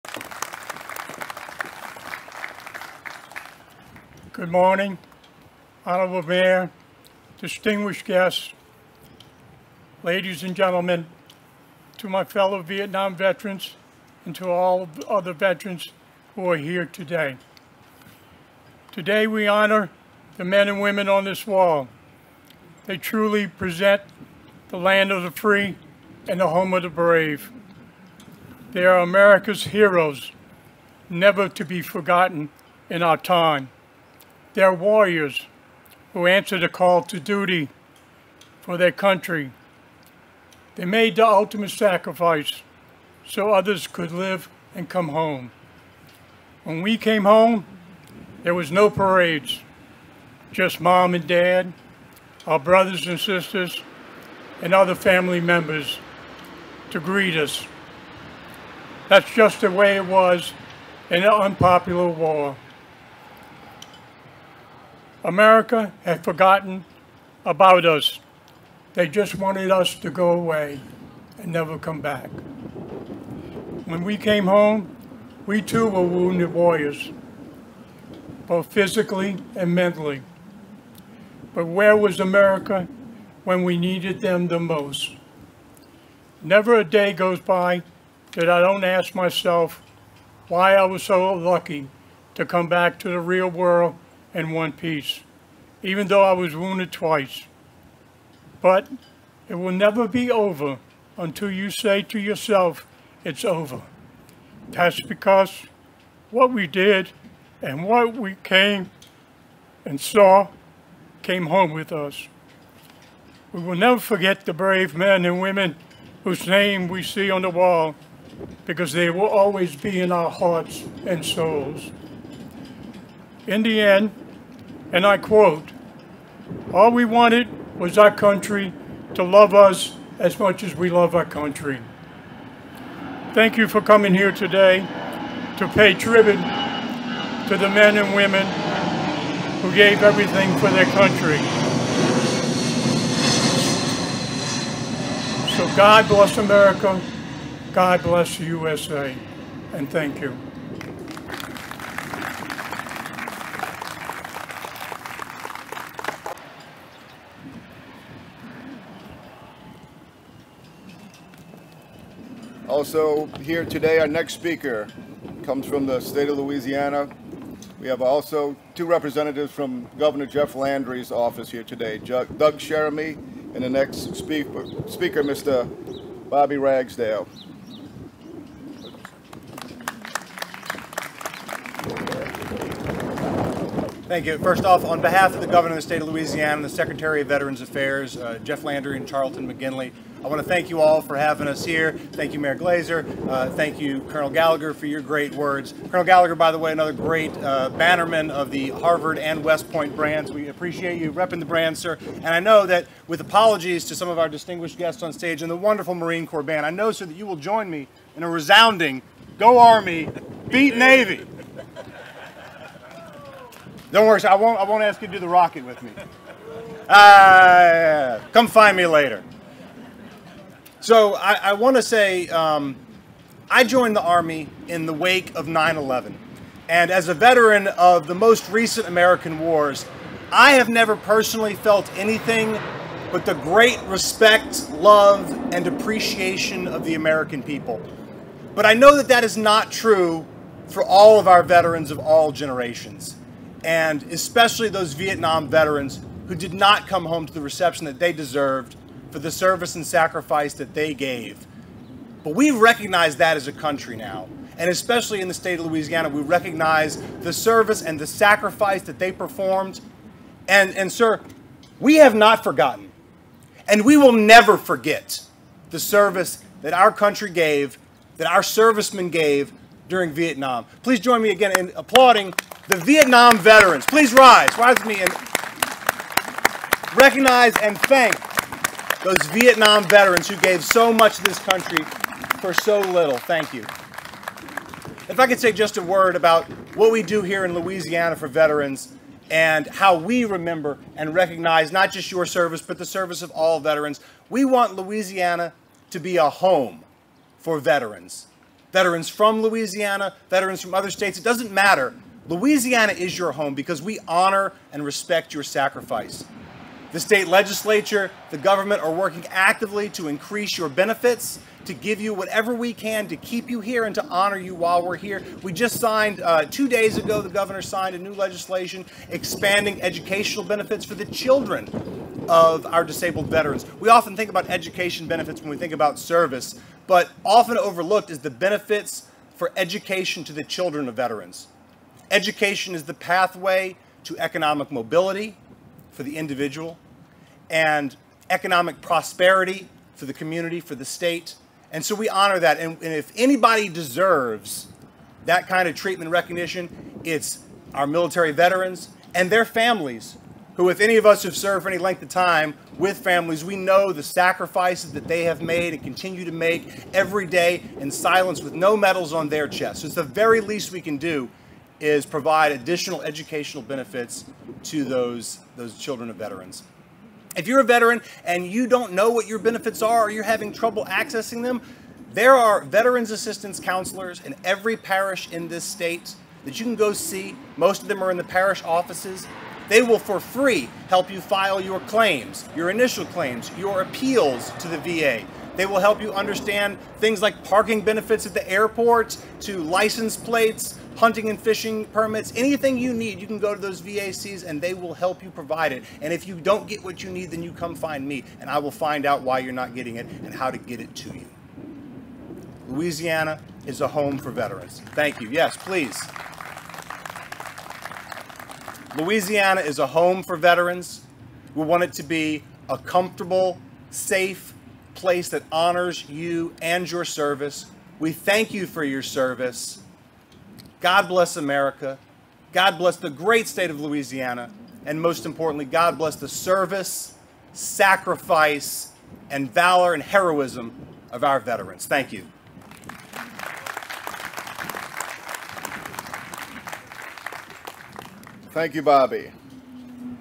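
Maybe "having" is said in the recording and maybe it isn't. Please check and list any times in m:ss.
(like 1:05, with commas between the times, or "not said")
3:11, 6:10.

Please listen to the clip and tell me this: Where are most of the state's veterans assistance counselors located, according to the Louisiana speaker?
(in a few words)
parish offices.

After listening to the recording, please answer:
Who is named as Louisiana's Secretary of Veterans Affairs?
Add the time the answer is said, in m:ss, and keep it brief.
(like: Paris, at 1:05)
Charlton Meginley, at 3:09.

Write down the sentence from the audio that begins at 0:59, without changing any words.
That's just the way it was in an unpopular war.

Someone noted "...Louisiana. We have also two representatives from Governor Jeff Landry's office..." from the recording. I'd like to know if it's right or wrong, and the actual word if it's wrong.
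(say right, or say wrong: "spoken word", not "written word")
right.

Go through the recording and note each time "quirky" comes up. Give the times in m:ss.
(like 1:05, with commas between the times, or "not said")
not said.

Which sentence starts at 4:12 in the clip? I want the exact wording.
But we recognize that as a country now.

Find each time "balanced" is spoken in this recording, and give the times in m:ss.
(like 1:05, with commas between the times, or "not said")
not said.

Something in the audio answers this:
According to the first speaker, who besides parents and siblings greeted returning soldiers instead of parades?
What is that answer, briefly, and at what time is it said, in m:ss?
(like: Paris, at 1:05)
other family members, at 0:54.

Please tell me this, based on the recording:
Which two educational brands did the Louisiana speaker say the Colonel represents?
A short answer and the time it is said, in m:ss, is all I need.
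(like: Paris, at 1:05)
Harvard and West Point, at 3:18.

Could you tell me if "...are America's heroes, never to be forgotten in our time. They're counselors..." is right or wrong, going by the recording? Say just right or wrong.
wrong.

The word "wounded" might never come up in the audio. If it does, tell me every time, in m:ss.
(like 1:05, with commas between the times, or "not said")
1:16, 1:36.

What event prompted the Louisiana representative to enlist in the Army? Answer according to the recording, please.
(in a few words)
9/11.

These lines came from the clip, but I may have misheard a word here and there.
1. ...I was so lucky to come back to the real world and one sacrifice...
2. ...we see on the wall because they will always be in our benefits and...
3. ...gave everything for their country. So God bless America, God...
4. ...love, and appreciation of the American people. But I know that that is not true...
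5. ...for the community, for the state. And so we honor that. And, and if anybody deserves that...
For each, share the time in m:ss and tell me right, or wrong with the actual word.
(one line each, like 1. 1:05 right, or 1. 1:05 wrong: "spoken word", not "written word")
1. 1:30 wrong: "piece", not "sacrifice"
2. 1:56 wrong: "hearts", not "benefits"
3. 2:19 right
4. 3:54 right
5. 5:39 right.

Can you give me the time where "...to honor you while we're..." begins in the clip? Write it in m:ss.
5:13.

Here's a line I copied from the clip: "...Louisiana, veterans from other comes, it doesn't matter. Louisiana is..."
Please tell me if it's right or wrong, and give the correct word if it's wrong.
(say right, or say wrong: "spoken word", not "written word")
wrong: "states", not "comes".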